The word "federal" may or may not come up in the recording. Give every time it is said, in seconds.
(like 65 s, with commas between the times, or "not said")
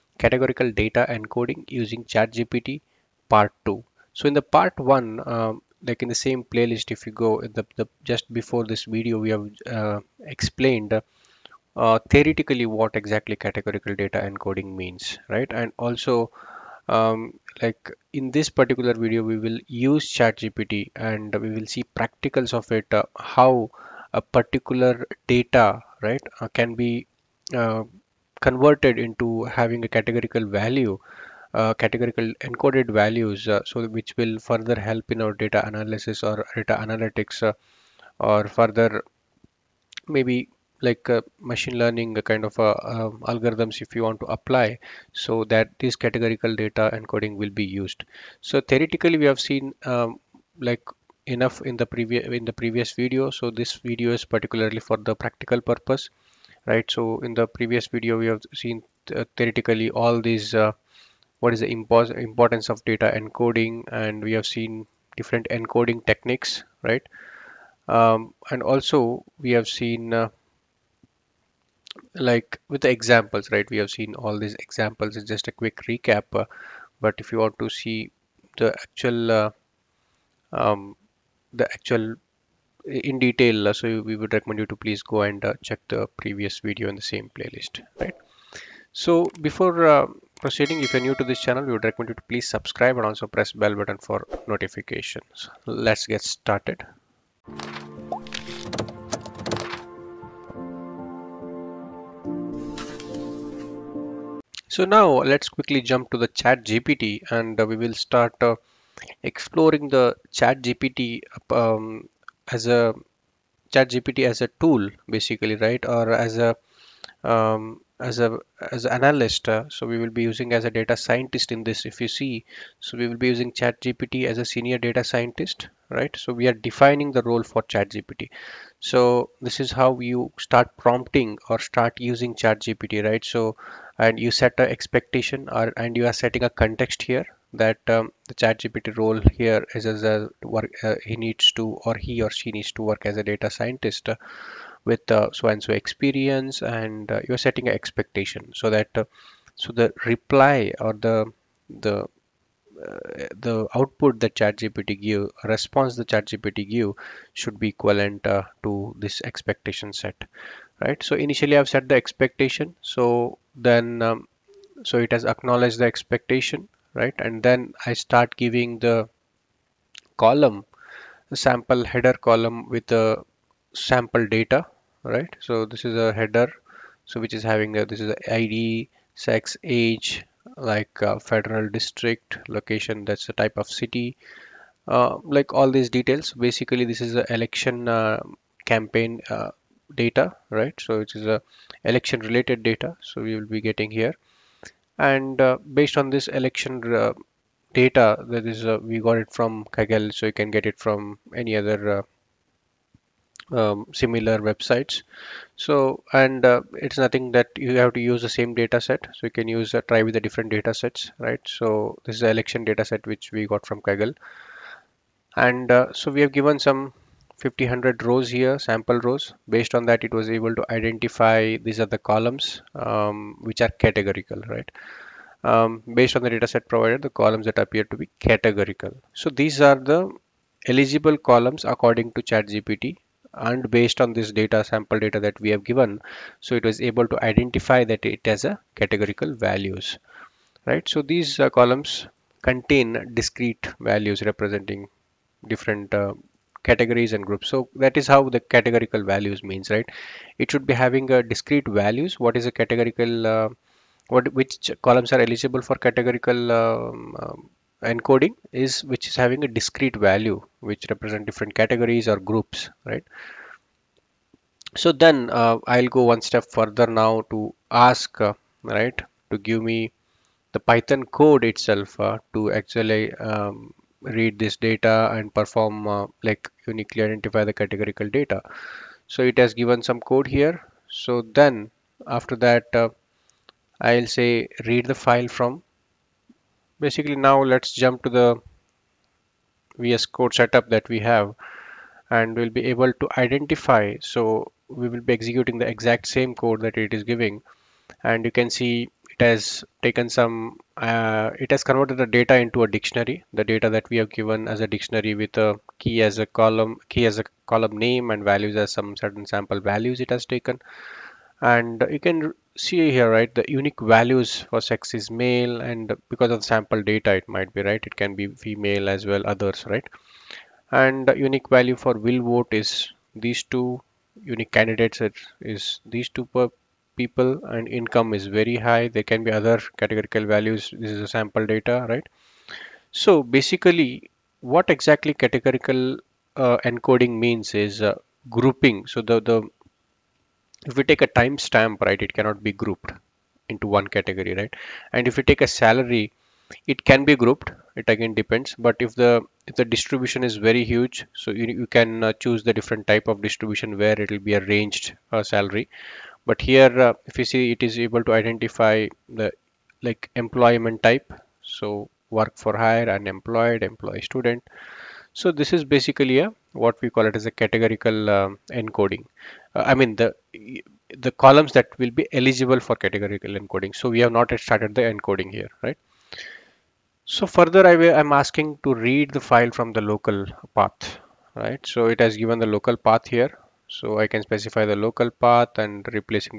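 181 s.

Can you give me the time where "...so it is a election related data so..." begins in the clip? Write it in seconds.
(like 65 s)
190 s.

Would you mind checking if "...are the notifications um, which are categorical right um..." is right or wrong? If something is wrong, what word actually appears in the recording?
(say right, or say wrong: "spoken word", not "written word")
wrong: "columns", not "notifications".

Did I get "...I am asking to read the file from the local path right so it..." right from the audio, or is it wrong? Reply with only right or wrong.
right.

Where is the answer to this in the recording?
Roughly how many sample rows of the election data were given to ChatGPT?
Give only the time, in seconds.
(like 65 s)
217 s.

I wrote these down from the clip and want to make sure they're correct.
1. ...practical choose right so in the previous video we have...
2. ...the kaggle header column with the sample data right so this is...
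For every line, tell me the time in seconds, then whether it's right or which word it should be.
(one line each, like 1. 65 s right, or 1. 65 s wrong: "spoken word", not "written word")
1. 55 s wrong: "purpose", not "choose"
2. 171 s wrong: "sample", not "kaggle".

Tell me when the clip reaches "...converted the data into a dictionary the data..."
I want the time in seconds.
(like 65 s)
301 s.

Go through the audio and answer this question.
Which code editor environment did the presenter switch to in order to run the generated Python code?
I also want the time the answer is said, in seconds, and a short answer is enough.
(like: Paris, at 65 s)
VS Code, at 289 s.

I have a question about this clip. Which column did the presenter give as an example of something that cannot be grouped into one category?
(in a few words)
Timestamp.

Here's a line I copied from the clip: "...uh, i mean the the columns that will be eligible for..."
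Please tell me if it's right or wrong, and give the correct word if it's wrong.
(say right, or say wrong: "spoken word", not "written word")
right.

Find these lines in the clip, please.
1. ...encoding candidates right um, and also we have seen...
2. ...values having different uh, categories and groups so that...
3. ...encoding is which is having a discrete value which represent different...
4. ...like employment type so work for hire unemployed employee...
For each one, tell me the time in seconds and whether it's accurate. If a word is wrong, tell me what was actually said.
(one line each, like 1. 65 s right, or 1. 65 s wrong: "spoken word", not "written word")
1. 65 s wrong: "techniques", not "candidates"
2. 243 s wrong: "representing", not "having"
3. 257 s right
4. 359 s right.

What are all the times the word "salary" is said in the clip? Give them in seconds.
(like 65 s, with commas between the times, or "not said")
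345 s, 355 s.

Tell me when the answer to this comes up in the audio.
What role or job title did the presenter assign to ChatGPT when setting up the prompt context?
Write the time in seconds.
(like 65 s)
124 s.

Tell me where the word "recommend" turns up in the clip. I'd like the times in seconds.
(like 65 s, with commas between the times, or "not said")
84 s, 91 s.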